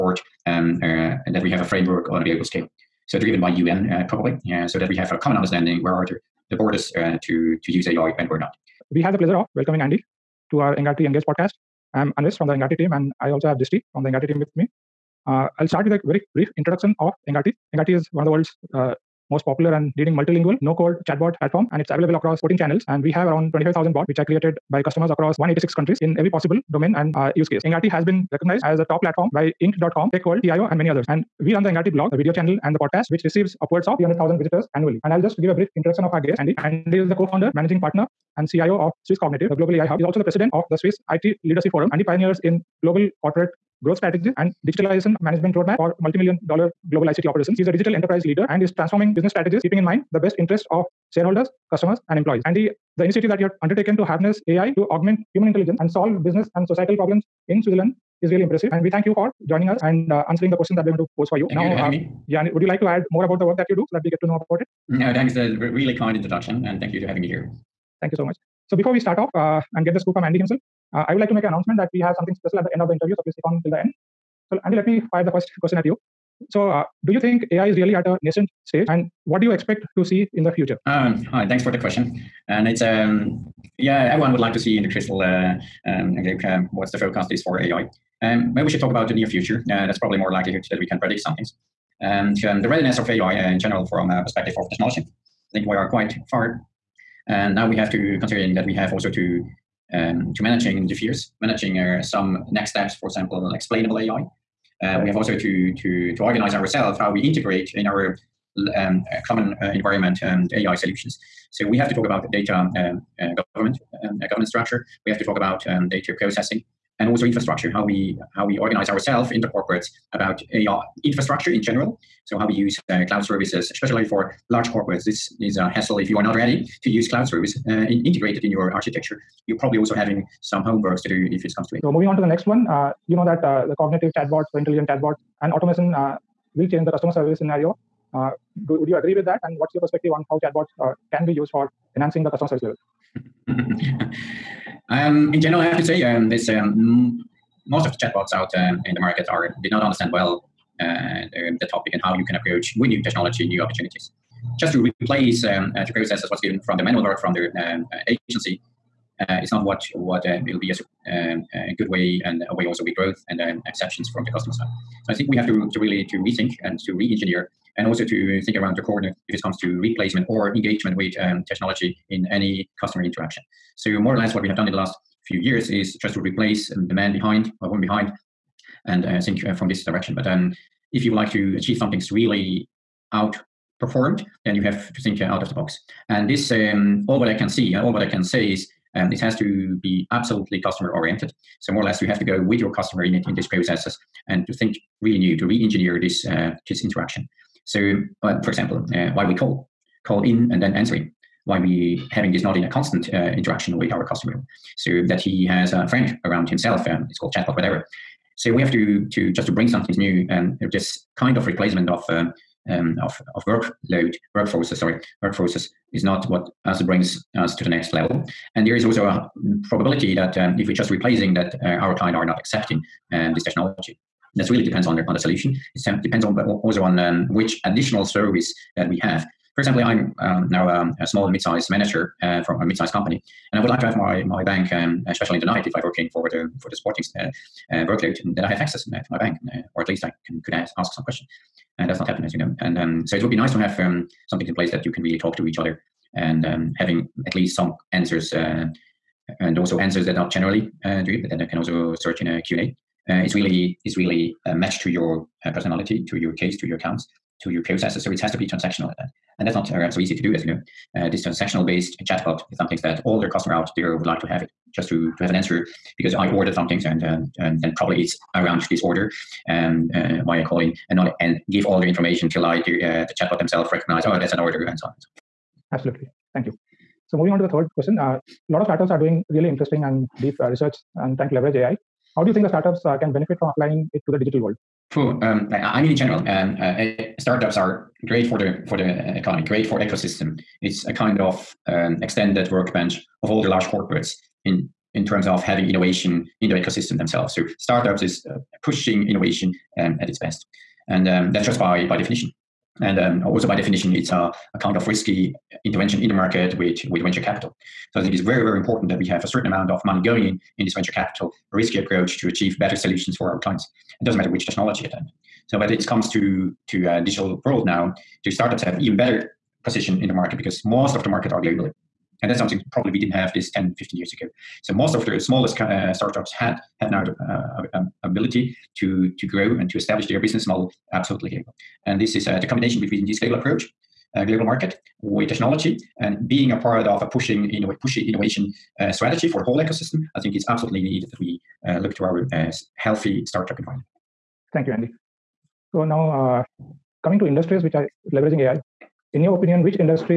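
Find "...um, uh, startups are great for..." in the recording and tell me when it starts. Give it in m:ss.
4:46.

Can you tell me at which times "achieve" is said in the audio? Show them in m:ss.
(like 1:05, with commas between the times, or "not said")
3:01, 5:12.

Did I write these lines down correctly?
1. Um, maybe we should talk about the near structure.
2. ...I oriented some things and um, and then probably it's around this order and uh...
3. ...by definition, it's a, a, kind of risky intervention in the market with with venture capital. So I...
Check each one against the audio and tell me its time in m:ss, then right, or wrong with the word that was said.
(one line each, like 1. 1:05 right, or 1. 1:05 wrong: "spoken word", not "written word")
1. 1:28 wrong: "future", not "structure"
2. 4:26 wrong: "ordered", not "oriented"
3. 5:03 right.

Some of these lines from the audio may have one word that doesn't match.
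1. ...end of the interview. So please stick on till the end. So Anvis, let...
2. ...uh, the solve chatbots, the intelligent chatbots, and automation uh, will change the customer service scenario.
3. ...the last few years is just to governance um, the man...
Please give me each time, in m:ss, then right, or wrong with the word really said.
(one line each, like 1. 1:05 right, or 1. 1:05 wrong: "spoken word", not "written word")
1. 1:12 wrong: "Andy", not "Anvis"
2. 2:13 wrong: "cognitive", not "solve"
3. 2:54 wrong: "replace", not "governance".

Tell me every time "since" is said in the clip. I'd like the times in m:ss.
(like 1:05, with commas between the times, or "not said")
not said.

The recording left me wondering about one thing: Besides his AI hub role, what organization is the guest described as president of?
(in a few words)
Swiss IT Leadership Forum.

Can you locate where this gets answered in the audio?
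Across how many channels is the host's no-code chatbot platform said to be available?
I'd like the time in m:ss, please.
0:22.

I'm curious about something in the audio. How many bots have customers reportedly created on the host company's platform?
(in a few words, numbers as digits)
25,000.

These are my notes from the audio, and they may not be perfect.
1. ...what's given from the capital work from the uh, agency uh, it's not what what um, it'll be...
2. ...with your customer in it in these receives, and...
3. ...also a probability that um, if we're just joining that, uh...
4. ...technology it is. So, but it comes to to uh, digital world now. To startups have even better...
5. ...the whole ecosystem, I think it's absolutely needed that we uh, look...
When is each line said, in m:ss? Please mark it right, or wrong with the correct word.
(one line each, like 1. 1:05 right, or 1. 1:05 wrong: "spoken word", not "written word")
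1. 2:36 wrong: "manual", not "capital"
2. 3:12 wrong: "processes", not "receives"
3. 3:38 wrong: "replacing", not "joining"
4. 5:14 right
5. 5:39 right.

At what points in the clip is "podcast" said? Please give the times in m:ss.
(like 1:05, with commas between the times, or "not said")
0:11, 0:32.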